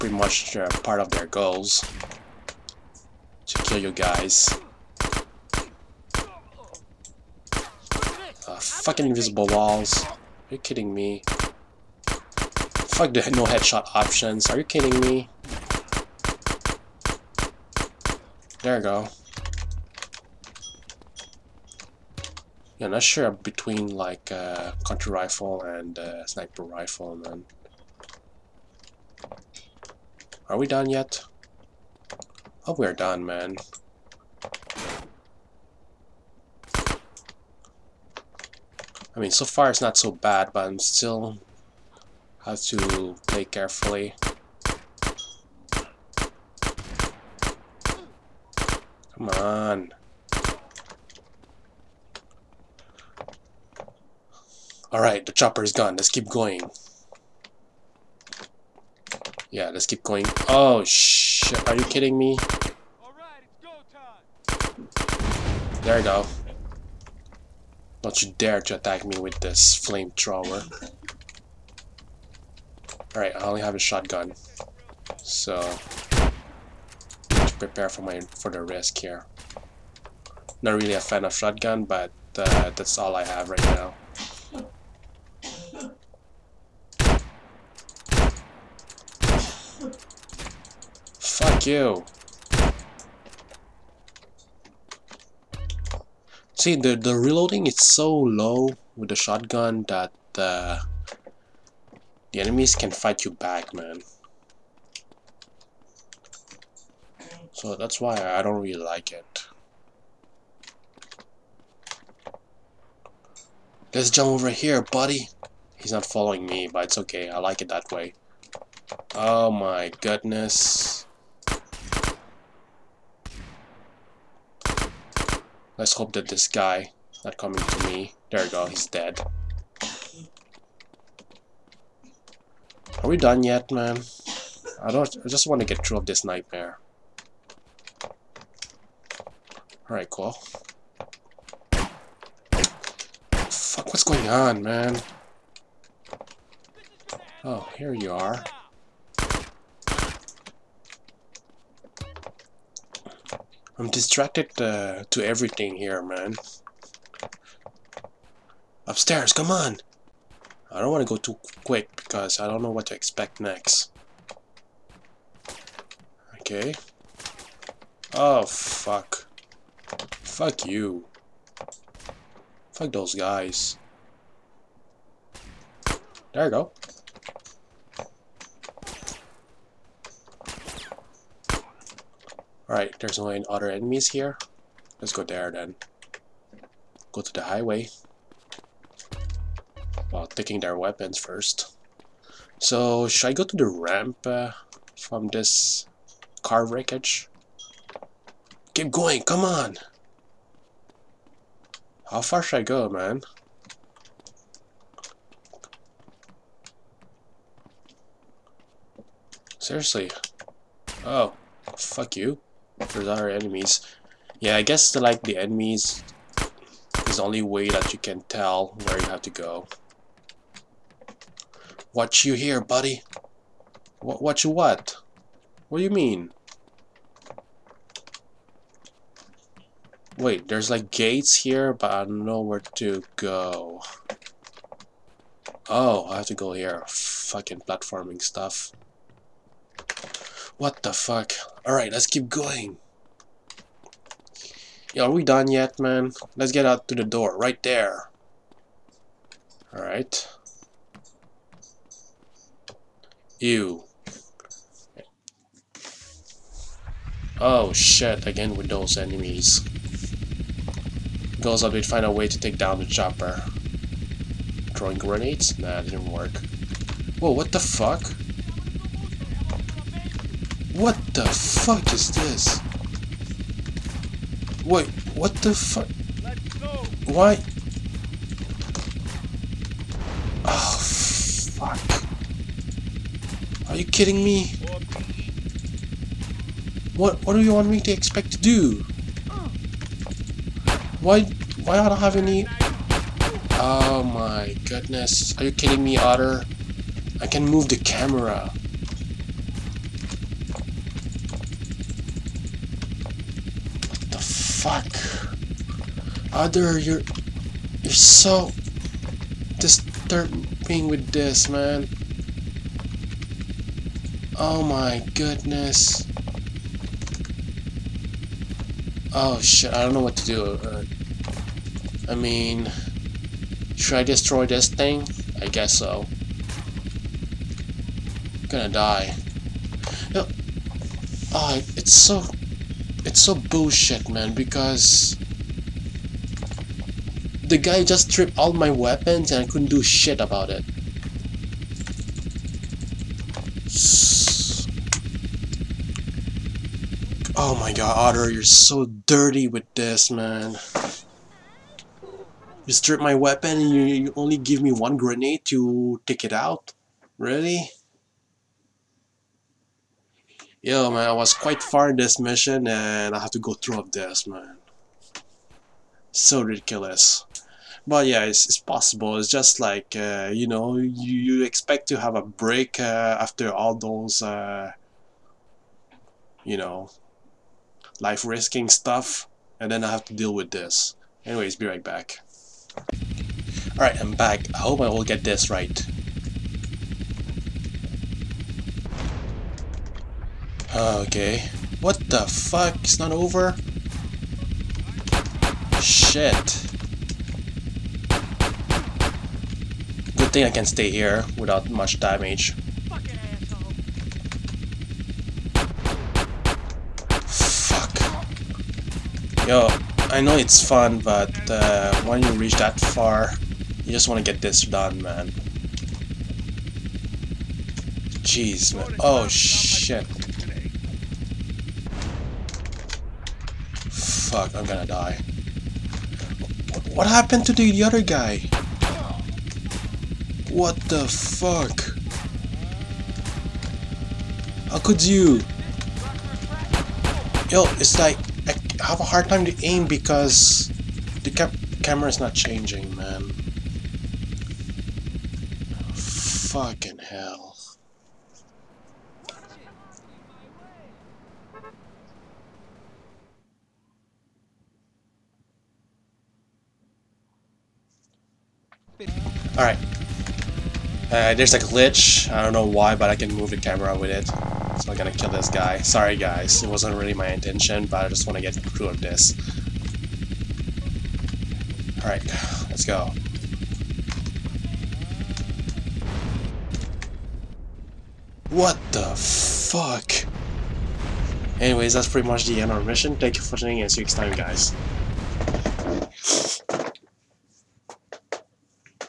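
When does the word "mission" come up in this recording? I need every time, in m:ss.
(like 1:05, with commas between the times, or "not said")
6:02, 8:02.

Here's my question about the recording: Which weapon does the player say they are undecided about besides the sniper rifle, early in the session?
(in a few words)
country rifle.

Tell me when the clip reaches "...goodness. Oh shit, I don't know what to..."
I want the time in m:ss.
5:15.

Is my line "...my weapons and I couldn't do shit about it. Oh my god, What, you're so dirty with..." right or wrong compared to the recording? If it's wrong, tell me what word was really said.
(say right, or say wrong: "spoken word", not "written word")
wrong: "Otter", not "What".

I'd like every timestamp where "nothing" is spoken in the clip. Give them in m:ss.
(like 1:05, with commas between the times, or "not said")
not said.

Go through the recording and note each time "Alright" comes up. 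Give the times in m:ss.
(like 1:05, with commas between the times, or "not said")
0:54, 1:13, 2:19, 3:02, 4:01, 4:09, 7:39, 7:52.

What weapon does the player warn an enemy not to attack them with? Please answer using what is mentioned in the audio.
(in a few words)
flamethrower.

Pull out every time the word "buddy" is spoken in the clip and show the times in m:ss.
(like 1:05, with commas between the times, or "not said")
1:54, 3:42.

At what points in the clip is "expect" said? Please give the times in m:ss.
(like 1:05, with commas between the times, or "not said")
2:42, 4:47, 6:11.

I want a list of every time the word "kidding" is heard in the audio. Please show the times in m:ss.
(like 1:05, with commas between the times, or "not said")
0:10, 0:14, 1:01, 4:43, 4:55.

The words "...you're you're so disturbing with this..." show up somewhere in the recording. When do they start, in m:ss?
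5:06.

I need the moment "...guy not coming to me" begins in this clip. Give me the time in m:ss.
2:06.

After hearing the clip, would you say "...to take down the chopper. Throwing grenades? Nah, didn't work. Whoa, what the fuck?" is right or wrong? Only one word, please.
right.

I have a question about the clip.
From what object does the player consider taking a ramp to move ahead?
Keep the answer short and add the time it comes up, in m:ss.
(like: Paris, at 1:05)
car wreckage, at 3:16.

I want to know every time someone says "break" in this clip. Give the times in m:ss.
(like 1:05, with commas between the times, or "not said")
6:12.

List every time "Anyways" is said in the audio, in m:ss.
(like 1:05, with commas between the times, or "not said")
6:21, 8:01.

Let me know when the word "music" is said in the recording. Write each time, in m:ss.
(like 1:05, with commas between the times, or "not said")
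not said.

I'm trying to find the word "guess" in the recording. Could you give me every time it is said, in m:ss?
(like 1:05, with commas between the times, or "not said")
3:34, 5:25.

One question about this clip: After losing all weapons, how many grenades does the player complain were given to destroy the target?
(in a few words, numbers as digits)
1.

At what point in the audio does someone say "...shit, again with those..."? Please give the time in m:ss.
4:17.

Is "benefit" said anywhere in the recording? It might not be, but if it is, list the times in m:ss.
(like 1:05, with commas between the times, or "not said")
not said.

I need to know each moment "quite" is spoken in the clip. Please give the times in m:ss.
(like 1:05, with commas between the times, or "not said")
6:01.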